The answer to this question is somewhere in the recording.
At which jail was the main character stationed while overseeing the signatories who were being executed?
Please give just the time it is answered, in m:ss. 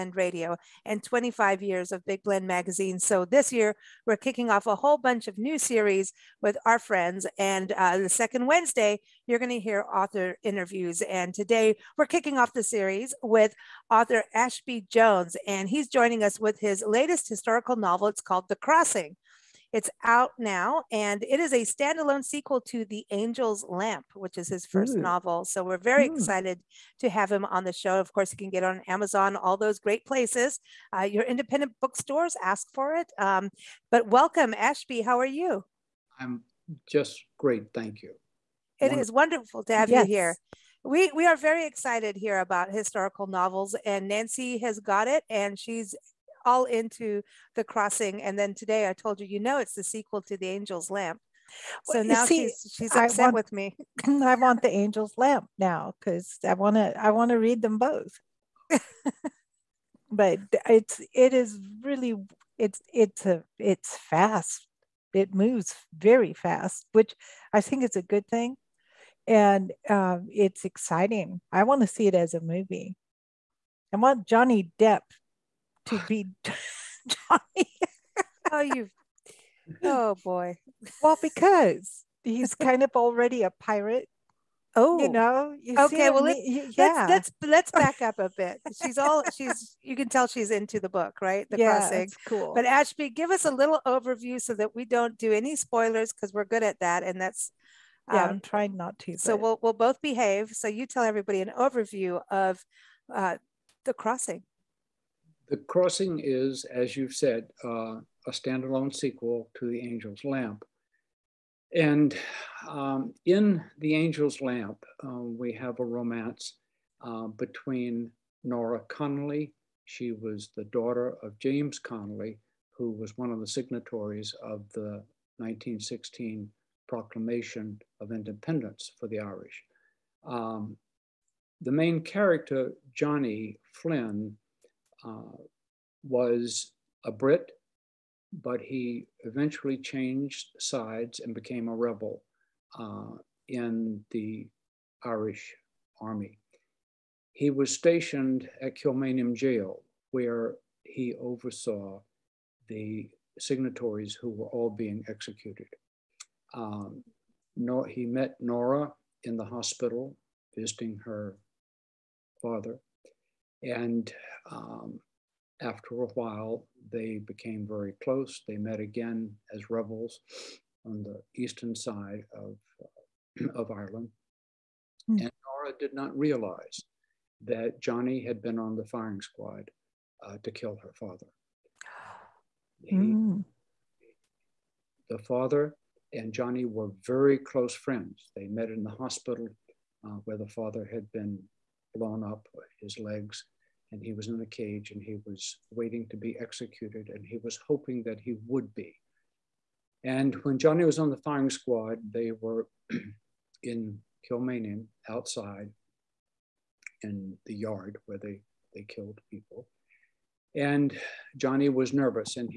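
2:28.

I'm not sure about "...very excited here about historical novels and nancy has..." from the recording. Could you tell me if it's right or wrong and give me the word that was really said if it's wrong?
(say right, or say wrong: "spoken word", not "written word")
right.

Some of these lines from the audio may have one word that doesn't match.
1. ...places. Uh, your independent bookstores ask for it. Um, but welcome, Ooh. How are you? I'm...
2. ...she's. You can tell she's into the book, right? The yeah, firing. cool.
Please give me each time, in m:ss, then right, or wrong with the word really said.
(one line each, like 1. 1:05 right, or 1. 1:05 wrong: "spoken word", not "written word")
1. 0:30 wrong: "Ashby", not "Ooh"
2. 1:29 wrong: "crossing", not "firing".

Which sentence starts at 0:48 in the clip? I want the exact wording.
And then today I told you, you know, it's the sequel to the Angel's Lamp.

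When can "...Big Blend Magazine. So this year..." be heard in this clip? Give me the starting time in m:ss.
0:02.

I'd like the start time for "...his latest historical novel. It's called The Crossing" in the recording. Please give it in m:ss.
0:16.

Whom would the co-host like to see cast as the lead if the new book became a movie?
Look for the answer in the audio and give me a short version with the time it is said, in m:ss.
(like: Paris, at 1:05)
Johnny Depp, at 1:14.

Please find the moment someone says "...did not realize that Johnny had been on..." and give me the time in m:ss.
2:55.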